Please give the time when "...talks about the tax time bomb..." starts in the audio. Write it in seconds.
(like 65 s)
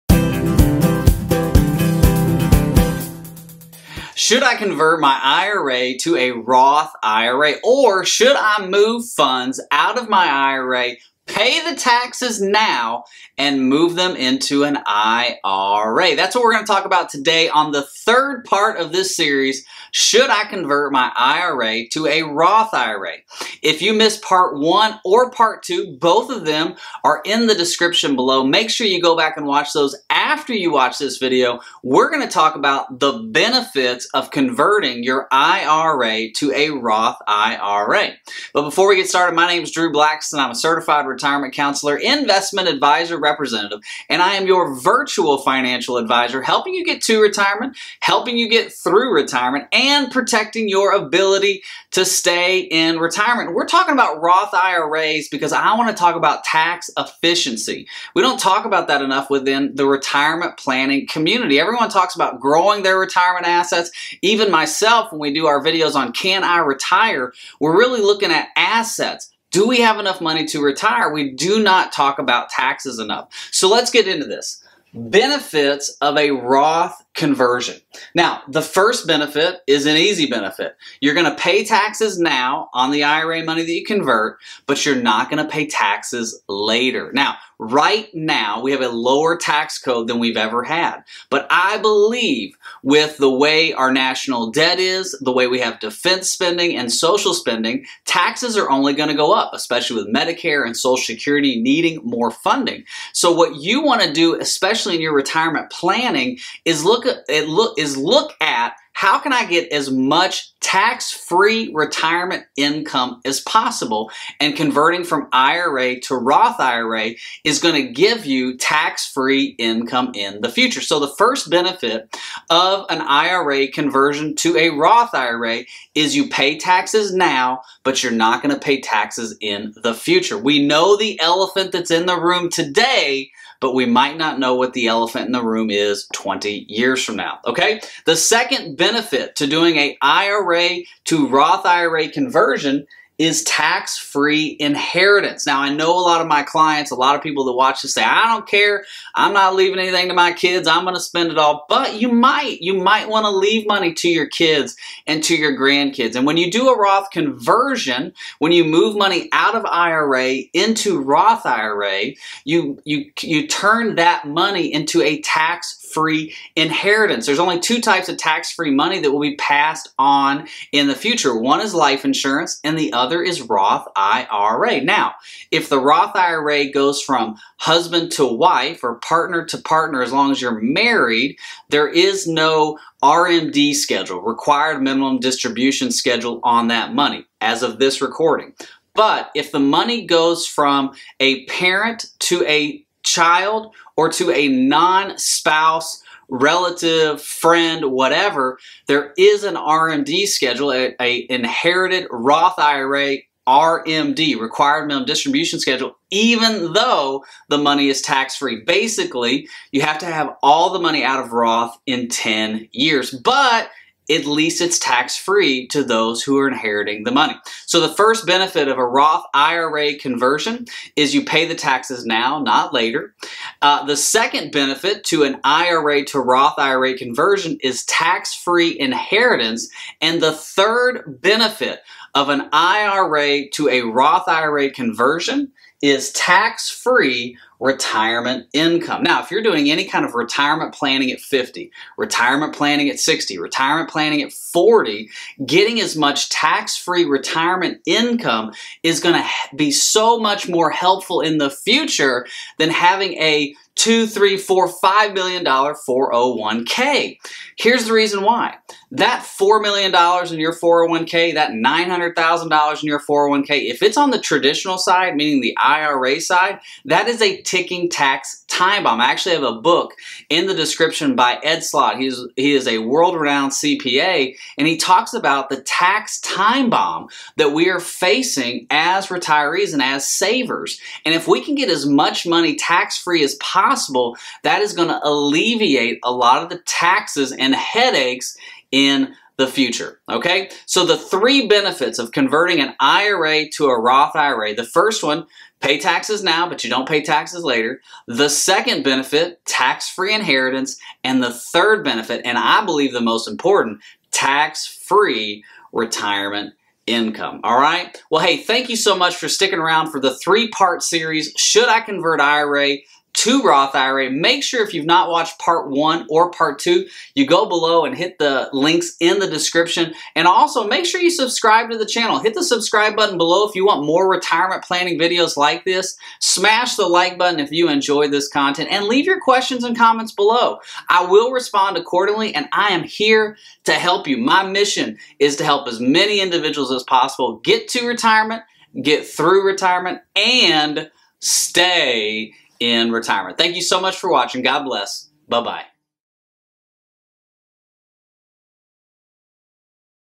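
274 s.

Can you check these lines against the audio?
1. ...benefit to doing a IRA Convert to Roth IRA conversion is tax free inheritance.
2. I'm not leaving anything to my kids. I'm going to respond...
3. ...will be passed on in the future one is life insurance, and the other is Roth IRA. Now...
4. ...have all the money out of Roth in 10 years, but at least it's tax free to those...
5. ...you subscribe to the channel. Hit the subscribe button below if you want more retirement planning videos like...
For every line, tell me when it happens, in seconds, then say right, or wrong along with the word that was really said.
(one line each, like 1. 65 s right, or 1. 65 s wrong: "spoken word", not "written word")
1. 138 s wrong: "IRA", not "Convert"
2. 149 s wrong: "spend", not "respond"
3. 169 s right
4. 210 s right
5. 321 s right.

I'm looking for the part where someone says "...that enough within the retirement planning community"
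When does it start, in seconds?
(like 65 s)
58 s.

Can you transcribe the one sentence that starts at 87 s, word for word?
Now, Right now, we have a lower tax code than we've ever had.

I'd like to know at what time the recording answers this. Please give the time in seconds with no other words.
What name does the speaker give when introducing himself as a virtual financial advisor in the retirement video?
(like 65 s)
39 s.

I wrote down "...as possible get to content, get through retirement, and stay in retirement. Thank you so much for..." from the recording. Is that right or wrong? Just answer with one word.
wrong.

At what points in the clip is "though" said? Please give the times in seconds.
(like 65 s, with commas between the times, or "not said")
206 s.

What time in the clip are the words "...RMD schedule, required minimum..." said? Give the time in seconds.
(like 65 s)
183 s.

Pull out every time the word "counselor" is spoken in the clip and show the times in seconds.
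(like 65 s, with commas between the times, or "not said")
41 s.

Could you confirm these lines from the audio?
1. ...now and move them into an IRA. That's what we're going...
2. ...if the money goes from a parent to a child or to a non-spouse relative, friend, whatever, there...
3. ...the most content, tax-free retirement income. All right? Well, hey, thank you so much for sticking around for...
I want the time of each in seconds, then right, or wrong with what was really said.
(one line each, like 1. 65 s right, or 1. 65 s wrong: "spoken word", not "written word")
1. 12 s right
2. 189 s right
3. 302 s wrong: "important", not "content".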